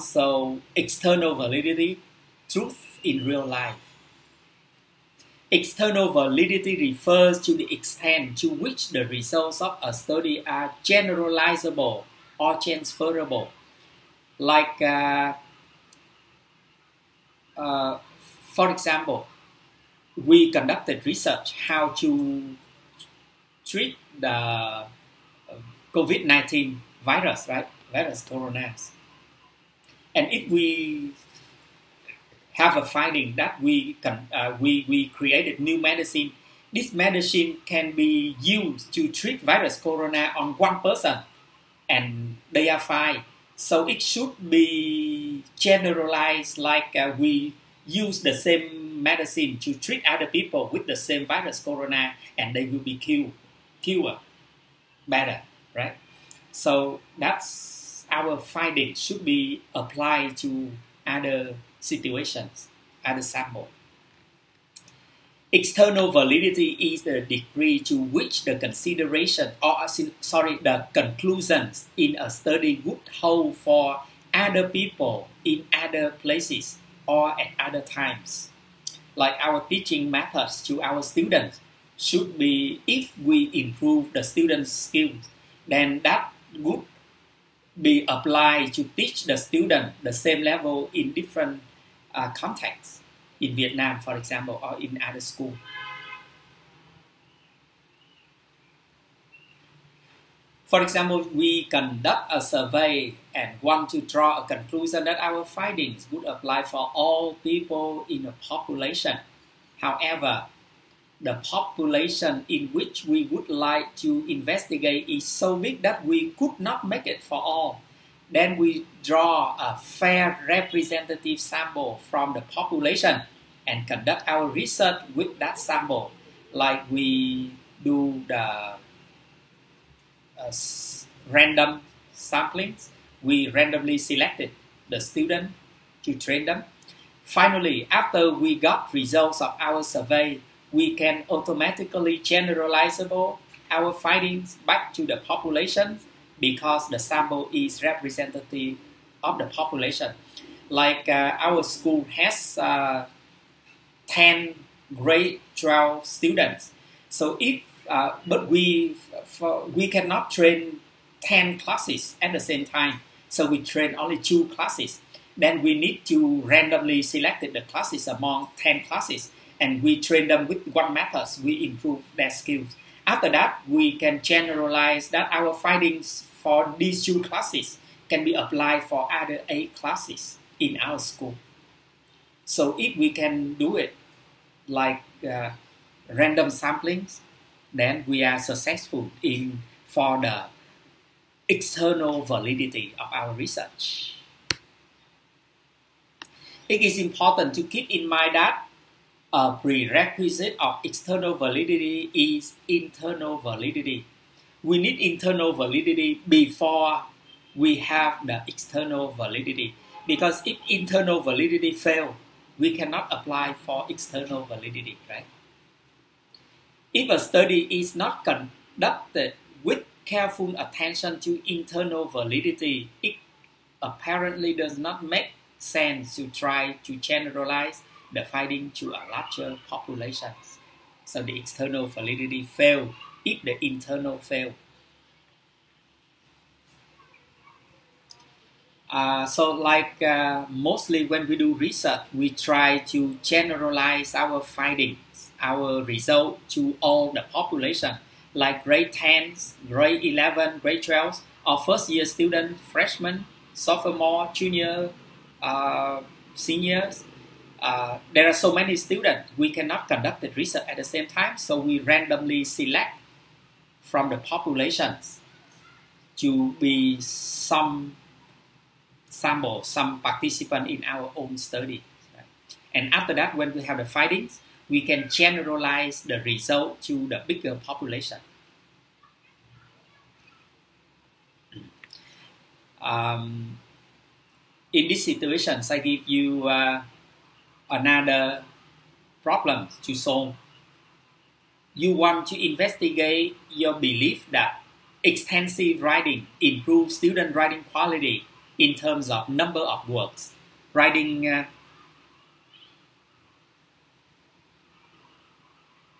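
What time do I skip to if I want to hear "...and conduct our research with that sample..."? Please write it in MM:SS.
02:03.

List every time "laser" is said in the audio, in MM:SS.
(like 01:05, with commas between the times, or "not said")
not said.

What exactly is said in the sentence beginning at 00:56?
So that's our finding should be applied to other situations, other sample.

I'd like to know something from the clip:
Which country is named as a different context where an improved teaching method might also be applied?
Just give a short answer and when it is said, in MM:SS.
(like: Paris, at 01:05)
Vietnam, at 01:33.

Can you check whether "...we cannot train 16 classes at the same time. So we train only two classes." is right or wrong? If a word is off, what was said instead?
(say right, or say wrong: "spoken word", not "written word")
wrong: "10", not "16".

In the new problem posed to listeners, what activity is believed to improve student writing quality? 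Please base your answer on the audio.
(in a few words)
Extensive writing.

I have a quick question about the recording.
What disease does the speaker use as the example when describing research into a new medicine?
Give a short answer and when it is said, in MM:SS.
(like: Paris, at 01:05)
COVID-19, at 00:25.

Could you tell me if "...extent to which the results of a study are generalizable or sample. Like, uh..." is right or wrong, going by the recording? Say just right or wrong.
wrong.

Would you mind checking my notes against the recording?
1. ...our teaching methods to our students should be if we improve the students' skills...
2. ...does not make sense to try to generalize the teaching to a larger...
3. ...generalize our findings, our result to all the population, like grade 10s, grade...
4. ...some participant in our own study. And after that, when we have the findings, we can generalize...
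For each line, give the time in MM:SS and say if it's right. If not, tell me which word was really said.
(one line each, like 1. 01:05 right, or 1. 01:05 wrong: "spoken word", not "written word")
1. 01:19 right
2. 03:44 wrong: "finding", not "teaching"
3. 04:03 right
4. 04:29 right.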